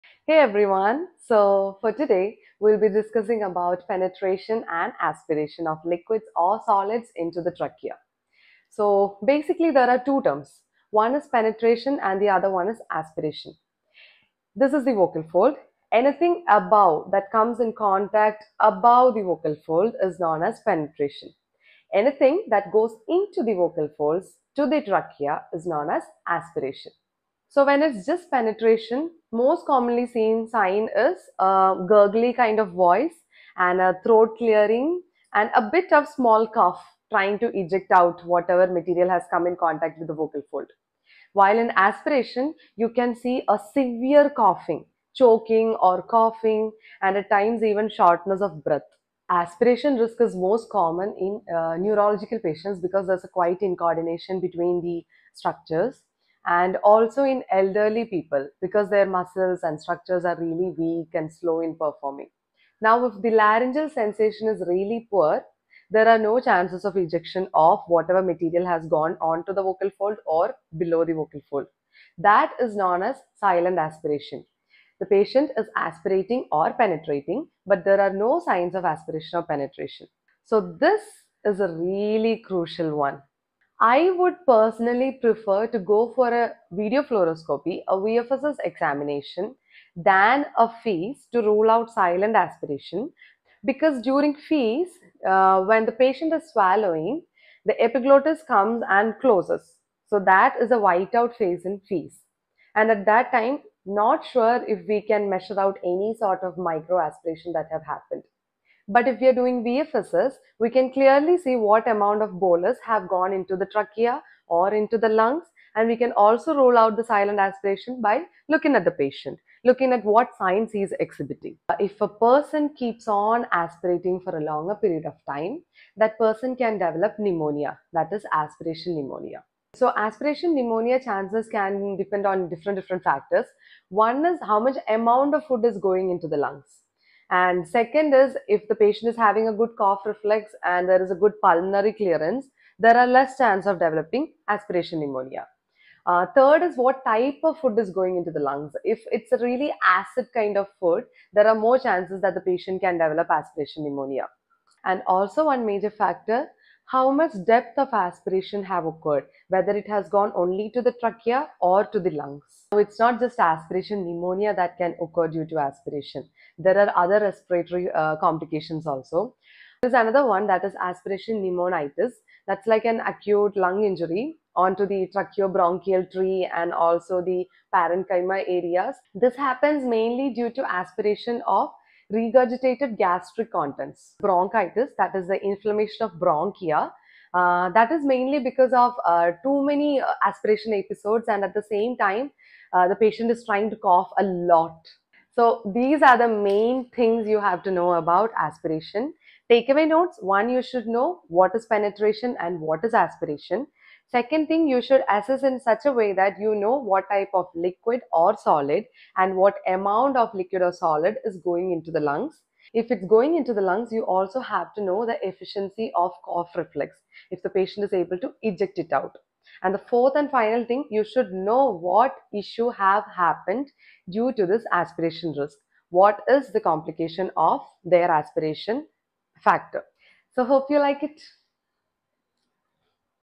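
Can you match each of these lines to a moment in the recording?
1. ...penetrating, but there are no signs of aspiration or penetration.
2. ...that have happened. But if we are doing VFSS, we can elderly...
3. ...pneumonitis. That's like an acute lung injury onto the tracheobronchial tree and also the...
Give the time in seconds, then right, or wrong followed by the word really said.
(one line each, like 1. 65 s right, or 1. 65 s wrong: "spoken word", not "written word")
1. 76 s right
2. 107 s wrong: "clearly", not "elderly"
3. 171 s right.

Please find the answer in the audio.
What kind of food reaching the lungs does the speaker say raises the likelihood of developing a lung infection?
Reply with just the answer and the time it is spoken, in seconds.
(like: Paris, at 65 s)
acid kind of food, at 149 s.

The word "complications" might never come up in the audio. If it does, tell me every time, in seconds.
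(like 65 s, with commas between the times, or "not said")
168 s, 226 s.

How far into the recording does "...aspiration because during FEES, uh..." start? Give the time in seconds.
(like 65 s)
92 s.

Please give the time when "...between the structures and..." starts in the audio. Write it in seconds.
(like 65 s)
54 s.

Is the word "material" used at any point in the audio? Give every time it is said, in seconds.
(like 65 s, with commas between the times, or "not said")
38 s, 68 s.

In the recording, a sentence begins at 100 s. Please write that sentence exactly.
So that is a whiteout phase in FEES.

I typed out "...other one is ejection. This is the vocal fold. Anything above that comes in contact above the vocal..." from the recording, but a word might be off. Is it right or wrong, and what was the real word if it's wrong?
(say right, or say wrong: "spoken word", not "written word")
wrong: "aspiration", not "ejection".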